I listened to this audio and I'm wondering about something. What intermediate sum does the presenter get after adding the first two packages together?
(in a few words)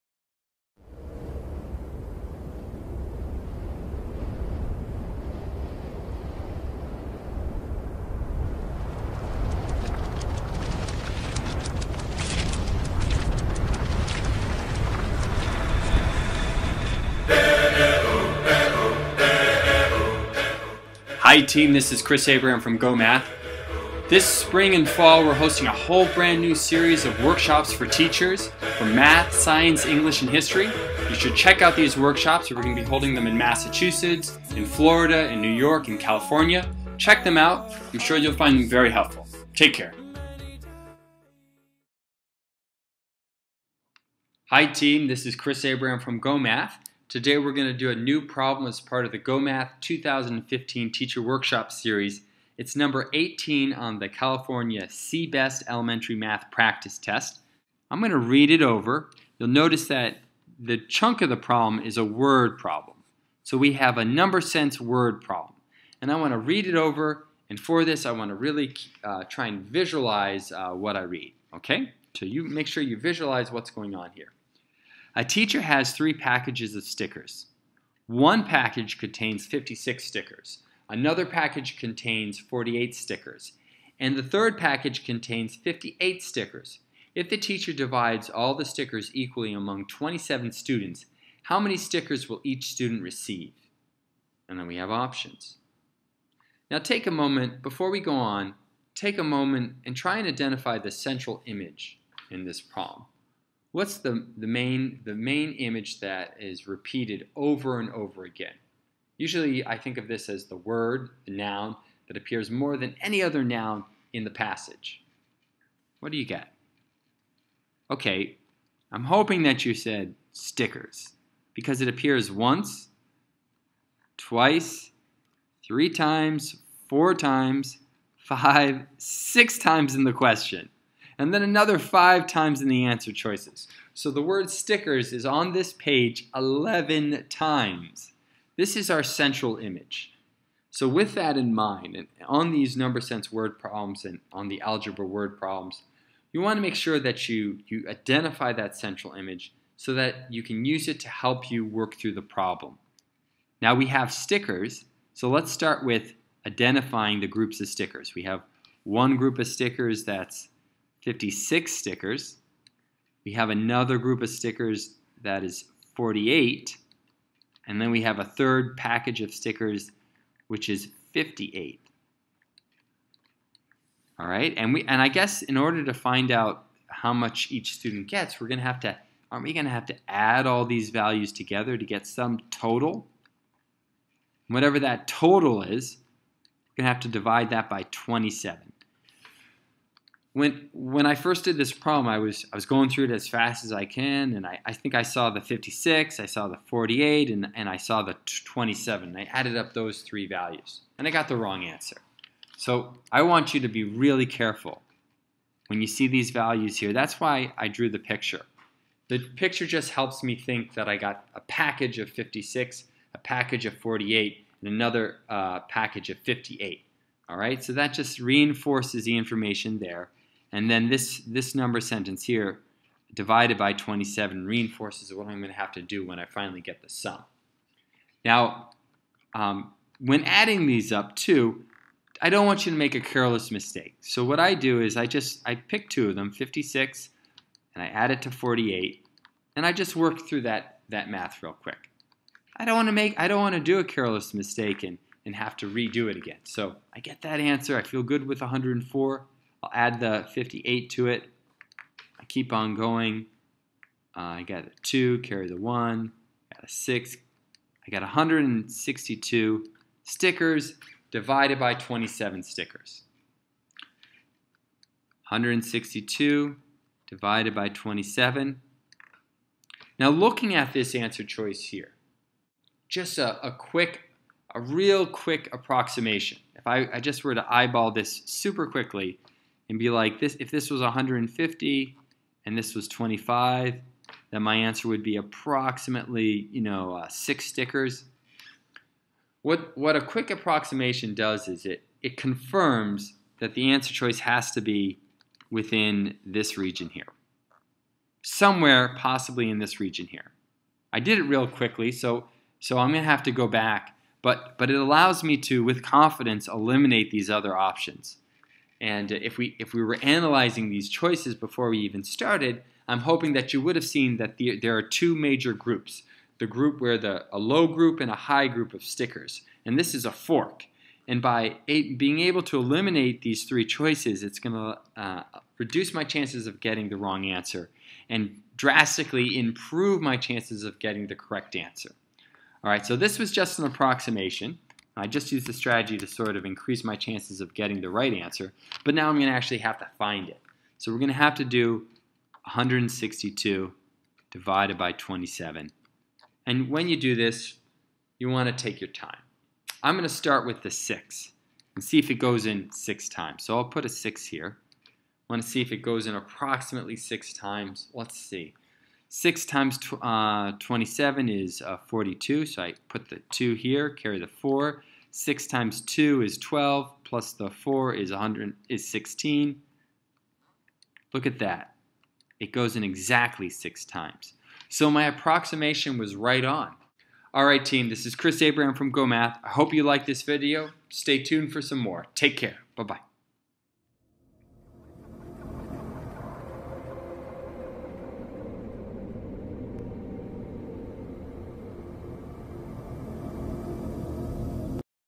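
104.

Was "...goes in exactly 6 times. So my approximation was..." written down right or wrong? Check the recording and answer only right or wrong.
right.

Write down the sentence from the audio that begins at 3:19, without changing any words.
I added up those three values, and I got the wrong answer.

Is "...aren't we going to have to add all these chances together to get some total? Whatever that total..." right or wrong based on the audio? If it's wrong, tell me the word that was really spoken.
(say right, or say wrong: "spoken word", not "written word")
wrong: "values", not "chances".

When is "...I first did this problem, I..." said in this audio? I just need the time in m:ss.
3:11.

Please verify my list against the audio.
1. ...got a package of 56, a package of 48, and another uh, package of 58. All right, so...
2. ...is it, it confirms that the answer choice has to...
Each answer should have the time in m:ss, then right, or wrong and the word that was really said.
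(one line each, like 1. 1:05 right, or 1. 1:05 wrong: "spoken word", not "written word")
1. 3:30 right
2. 4:51 right.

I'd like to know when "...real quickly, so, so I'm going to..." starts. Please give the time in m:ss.
5:01.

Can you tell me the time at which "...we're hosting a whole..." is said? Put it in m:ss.
0:25.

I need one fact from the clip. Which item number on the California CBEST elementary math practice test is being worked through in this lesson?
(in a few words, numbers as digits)
18.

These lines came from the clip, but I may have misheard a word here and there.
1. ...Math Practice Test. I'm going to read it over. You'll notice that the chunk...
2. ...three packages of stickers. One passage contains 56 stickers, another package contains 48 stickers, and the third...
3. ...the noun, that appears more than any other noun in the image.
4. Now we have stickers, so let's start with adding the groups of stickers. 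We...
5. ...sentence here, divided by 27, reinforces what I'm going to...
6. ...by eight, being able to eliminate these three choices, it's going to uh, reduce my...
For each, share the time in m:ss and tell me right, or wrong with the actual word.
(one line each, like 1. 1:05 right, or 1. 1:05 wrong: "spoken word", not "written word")
1. 0:56 right
2. 1:15 wrong: "package", not "passage"
3. 1:51 wrong: "passage", not "image"
4. 2:33 wrong: "identifying", not "adding"
5. 3:41 right
6. 5:21 right.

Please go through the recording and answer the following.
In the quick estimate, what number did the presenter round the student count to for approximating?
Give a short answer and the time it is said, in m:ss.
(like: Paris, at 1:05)
25, at 4:42.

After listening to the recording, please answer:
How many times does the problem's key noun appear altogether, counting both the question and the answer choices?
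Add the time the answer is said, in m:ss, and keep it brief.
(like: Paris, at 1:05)
11, at 2:16.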